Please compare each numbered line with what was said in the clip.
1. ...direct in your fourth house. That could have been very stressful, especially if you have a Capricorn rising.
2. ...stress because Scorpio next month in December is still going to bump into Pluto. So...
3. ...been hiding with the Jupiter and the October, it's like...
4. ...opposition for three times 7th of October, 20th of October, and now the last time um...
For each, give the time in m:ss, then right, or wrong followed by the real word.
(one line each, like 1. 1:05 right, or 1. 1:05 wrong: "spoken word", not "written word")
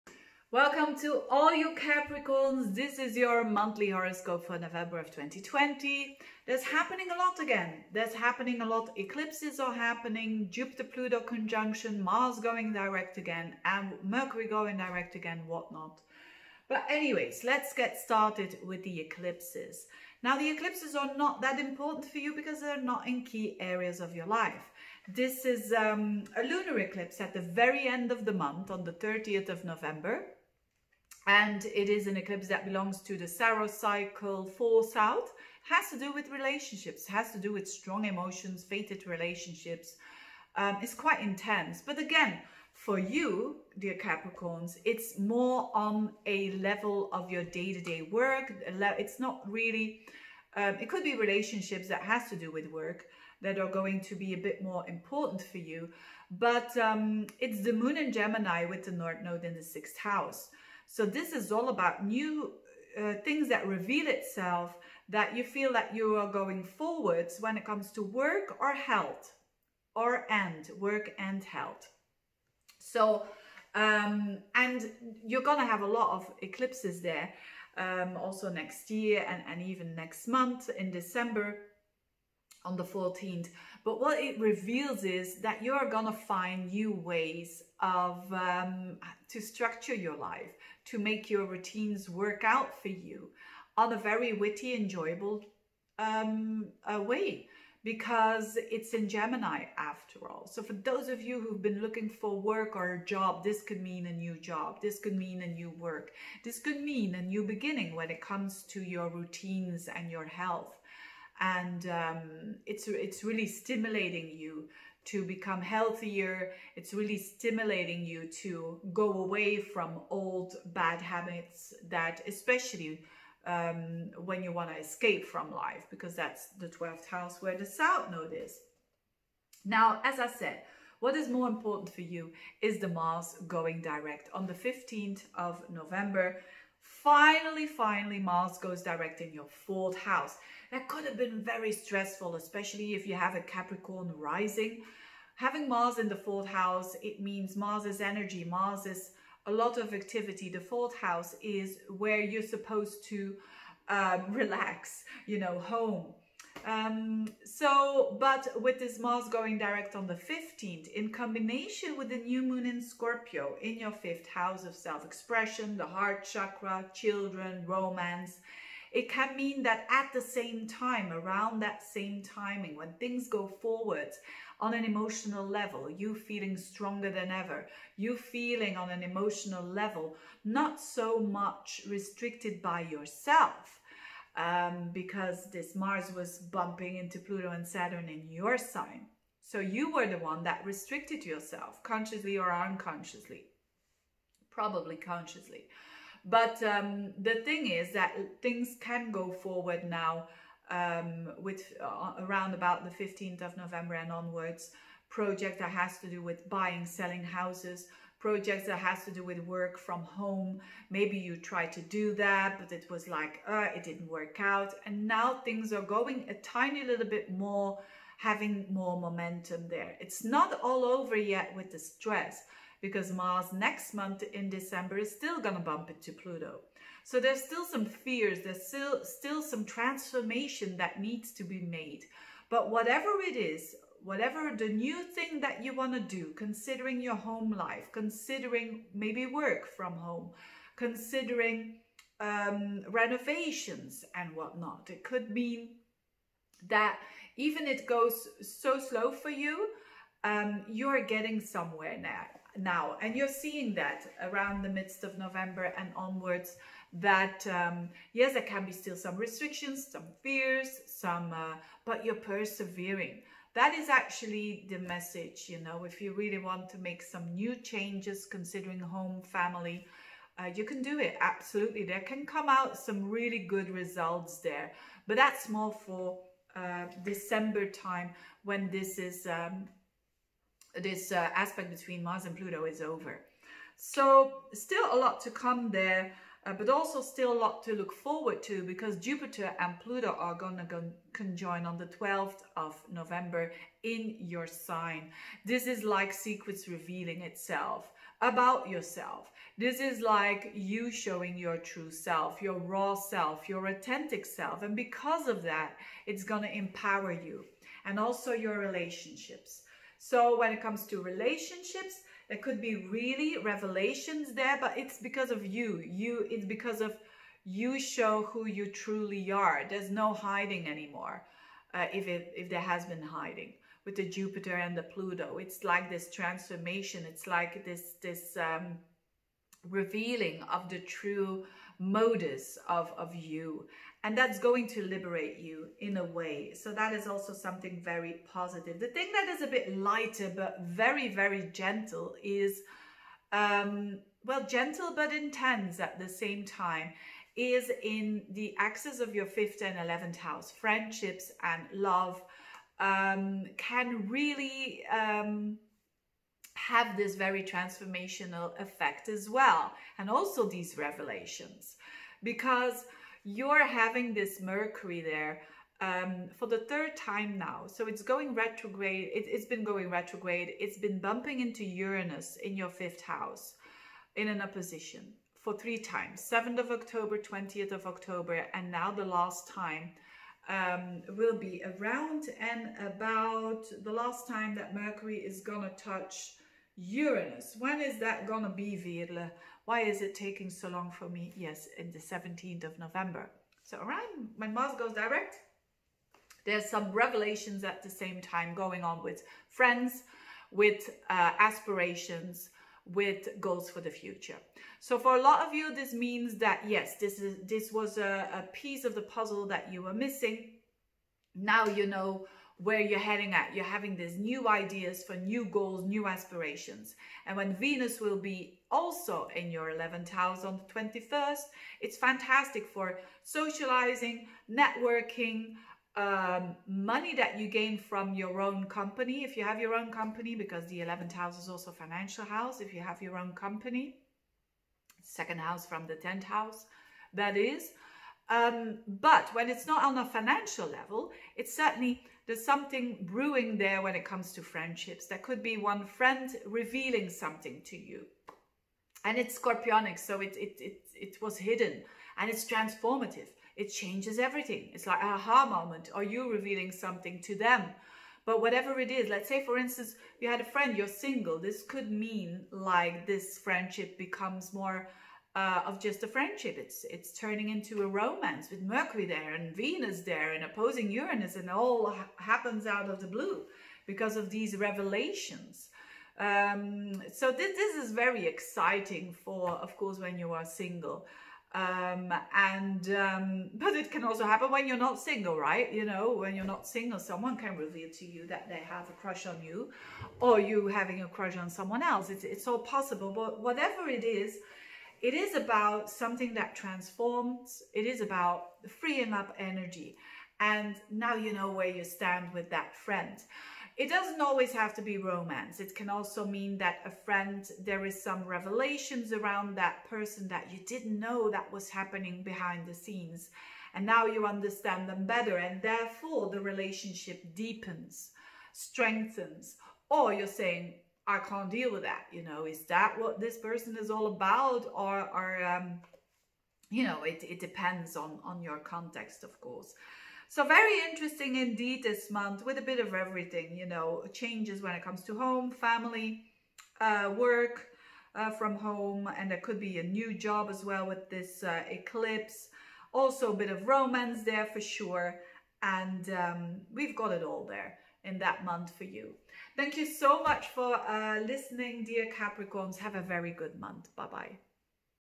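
1. 2:18 right
2. 3:41 wrong: "Mars", not "Scorpio"
3. 5:22 wrong: "Pluto", not "October"
4. 6:14 right.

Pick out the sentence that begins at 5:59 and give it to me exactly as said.
And also these revelations, because you're having this Mercury there um, for the third time now.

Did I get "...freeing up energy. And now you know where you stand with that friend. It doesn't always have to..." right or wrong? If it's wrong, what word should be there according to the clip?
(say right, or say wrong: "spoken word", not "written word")
right.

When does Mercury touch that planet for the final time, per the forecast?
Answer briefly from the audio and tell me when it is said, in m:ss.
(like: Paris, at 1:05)
17th of November, at 6:31.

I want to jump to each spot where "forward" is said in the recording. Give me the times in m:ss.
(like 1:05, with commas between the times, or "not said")
1:06, 2:53, 3:19, 4:47.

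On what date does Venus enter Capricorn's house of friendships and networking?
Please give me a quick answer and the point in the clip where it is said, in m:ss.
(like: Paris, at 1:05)
21st, at 7:00.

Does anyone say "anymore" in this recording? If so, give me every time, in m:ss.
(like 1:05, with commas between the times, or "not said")
5:20.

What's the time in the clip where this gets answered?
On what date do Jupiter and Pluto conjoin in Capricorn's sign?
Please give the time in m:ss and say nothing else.
4:51.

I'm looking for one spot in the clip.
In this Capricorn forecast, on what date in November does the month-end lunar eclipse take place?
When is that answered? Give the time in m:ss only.
0:28.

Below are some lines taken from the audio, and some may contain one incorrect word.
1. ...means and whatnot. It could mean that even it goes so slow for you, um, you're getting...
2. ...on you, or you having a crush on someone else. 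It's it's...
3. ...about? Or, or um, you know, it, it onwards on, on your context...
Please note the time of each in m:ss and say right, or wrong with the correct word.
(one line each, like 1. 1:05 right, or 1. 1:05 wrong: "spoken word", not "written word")
1. 4:02 wrong: "renovations", not "means"
2. 8:09 right
3. 8:44 wrong: "depends", not "onwards".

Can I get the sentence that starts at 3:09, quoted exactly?
So you were the one that restricted yourself, consciously or unconsciously.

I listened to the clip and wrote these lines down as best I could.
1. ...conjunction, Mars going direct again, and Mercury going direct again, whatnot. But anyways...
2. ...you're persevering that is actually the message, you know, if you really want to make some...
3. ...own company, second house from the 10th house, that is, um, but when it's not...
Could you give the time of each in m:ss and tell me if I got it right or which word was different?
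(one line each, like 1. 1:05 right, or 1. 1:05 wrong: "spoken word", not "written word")
1. 0:11 right
2. 4:22 right
3. 7:13 right.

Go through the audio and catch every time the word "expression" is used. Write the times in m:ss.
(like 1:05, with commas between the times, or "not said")
2:44.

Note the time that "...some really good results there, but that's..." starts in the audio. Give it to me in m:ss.
4:32.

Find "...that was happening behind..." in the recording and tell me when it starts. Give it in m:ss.
8:31.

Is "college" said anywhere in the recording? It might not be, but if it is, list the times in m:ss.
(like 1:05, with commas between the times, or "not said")
not said.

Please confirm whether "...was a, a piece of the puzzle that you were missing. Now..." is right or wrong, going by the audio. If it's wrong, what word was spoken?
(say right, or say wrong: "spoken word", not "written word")
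right.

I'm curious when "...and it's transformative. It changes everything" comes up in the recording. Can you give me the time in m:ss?
7:32.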